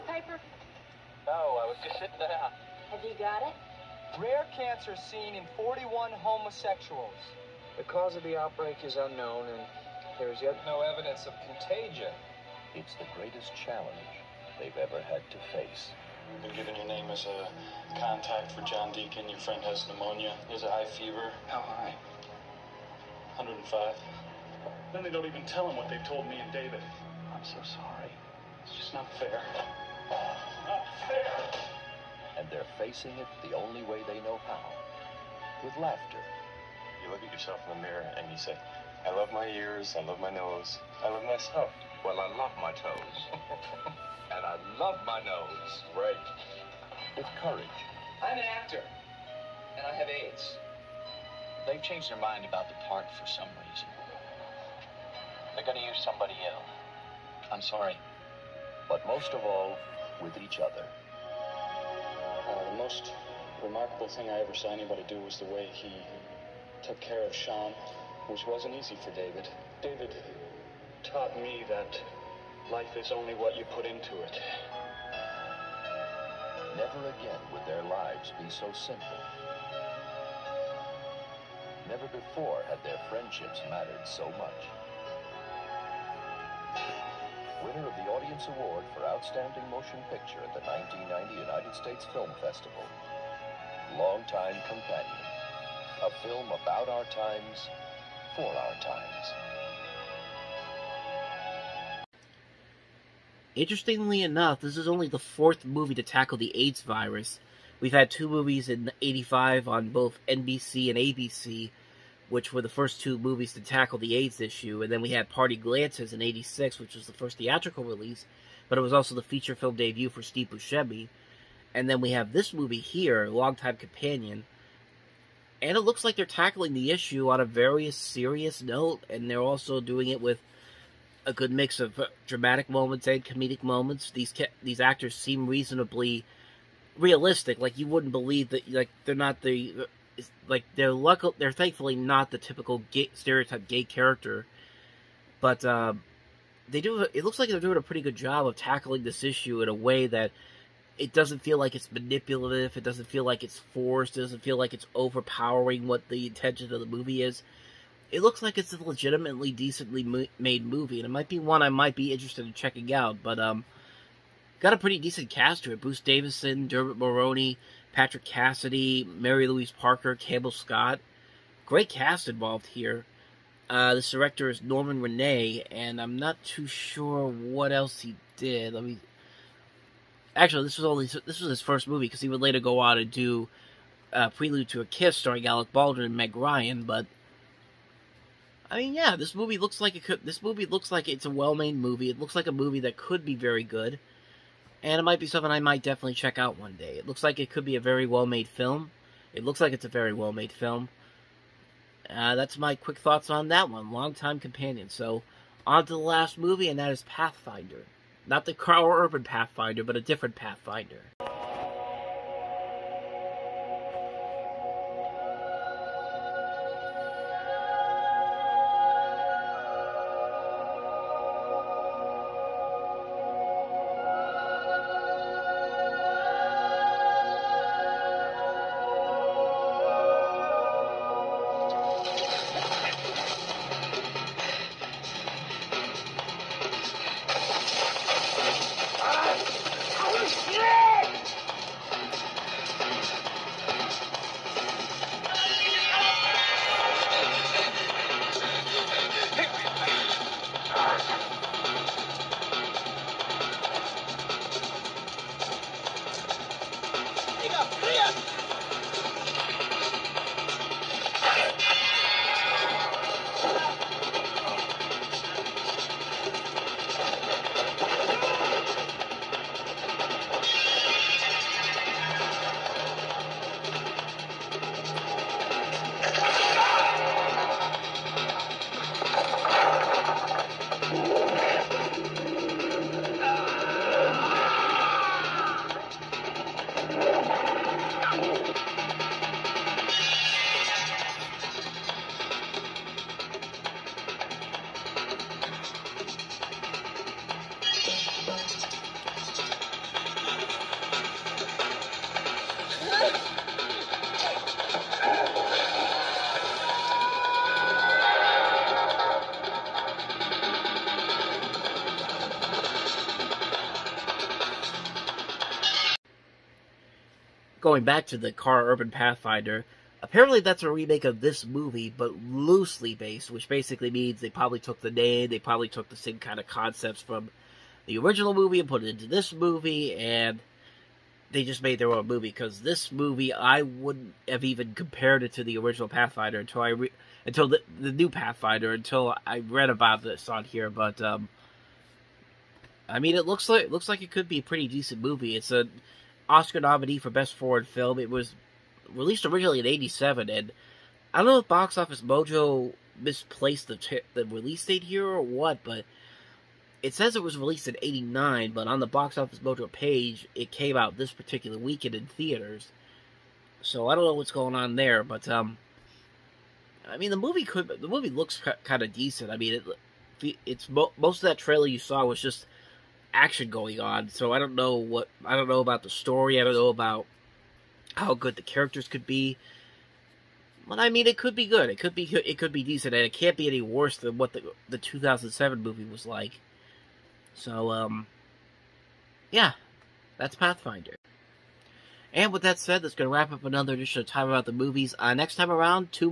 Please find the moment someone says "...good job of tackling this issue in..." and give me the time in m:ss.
2:28.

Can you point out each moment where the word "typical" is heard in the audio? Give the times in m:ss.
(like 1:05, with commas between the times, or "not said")
2:22.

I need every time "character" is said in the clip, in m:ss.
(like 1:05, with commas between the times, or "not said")
2:23, 6:18.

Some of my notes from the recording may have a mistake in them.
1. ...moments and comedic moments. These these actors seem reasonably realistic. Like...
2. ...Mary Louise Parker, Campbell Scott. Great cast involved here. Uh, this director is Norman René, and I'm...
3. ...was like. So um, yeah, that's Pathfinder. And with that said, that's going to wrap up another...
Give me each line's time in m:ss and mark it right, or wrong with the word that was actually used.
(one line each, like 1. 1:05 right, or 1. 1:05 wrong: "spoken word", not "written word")
1. 2:12 right
2. 2:49 right
3. 6:25 right.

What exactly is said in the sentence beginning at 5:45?
It's a Oscar nominee for Best Foreign Film.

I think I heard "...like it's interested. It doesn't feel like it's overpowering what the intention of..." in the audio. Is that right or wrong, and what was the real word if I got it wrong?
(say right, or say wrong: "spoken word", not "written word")
wrong: "forced", not "interested".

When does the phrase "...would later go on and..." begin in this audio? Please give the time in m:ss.
3:02.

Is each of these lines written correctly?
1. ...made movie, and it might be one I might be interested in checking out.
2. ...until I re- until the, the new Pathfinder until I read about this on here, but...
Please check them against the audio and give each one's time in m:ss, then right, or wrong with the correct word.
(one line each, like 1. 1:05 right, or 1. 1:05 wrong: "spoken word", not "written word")
1. 2:40 right
2. 5:36 right.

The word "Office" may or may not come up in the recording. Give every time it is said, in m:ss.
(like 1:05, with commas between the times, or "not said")
5:51, 5:59.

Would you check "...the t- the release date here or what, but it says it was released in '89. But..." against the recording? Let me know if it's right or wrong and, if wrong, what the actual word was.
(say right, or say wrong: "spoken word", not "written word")
right.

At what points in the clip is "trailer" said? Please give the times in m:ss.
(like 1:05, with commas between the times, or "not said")
6:11.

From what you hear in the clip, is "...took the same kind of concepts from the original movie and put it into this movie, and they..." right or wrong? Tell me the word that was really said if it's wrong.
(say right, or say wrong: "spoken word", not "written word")
right.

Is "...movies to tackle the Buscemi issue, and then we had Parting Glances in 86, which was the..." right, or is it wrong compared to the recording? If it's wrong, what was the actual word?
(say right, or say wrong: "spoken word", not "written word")
wrong: "AIDS", not "Buscemi".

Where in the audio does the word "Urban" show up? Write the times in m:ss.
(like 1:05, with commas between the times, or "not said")
3:28, 5:18.